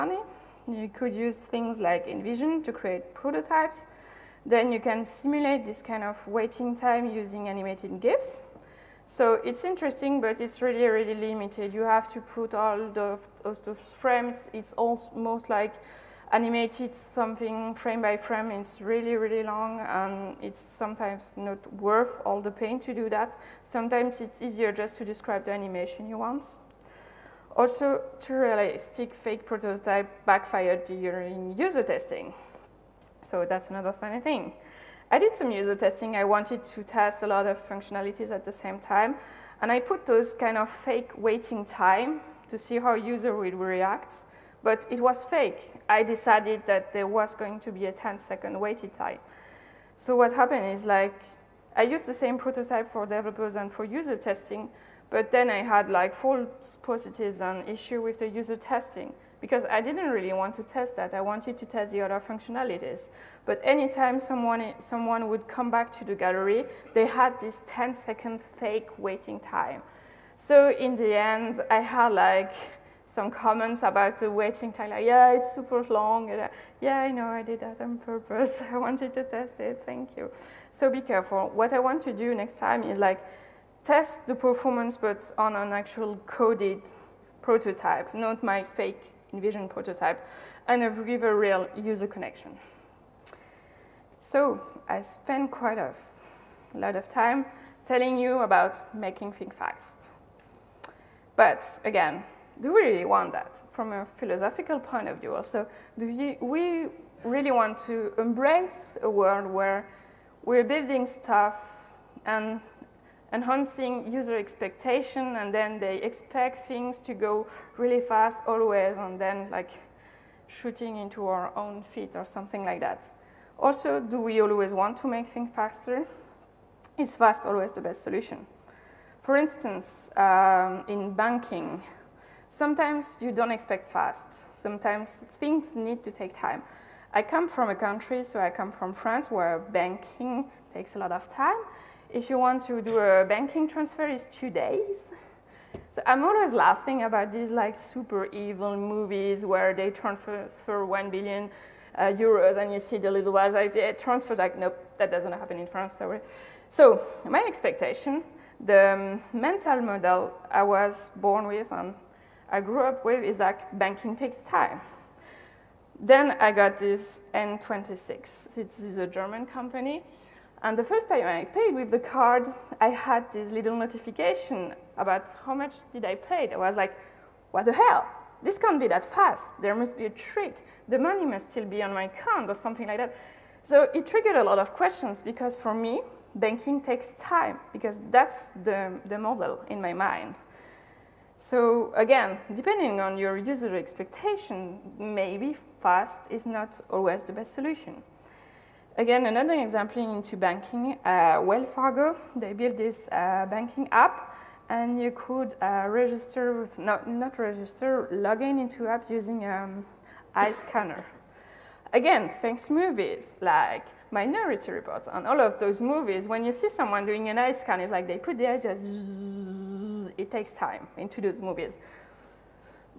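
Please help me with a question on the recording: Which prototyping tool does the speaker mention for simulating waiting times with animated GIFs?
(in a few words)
InVision.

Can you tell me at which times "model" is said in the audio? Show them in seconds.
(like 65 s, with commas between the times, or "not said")
159 s, 189 s.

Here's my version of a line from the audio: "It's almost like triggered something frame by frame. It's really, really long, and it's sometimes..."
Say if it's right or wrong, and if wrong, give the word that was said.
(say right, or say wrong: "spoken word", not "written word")
wrong: "animated", not "triggered".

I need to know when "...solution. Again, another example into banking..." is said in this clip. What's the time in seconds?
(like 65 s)
197 s.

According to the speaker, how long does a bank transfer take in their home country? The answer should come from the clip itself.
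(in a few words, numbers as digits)
2 days.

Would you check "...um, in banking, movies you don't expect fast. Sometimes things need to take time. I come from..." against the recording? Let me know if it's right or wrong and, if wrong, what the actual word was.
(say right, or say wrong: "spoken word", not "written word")
wrong: "sometimes", not "movies".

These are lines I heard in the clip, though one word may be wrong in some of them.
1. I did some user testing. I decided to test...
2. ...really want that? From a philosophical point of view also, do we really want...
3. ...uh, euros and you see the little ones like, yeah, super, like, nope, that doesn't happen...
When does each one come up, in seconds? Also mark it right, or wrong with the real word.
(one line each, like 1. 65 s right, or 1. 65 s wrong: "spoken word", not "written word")
1. 35 s wrong: "wanted", not "decided"
2. 102 s right
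3. 151 s wrong: "transfer", not "super".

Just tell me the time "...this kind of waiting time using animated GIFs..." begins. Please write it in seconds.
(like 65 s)
5 s.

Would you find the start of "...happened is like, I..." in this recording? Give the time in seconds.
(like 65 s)
50 s.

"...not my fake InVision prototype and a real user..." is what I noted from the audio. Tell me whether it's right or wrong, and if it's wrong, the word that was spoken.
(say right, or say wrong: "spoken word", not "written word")
wrong: "Vision", not "InVision".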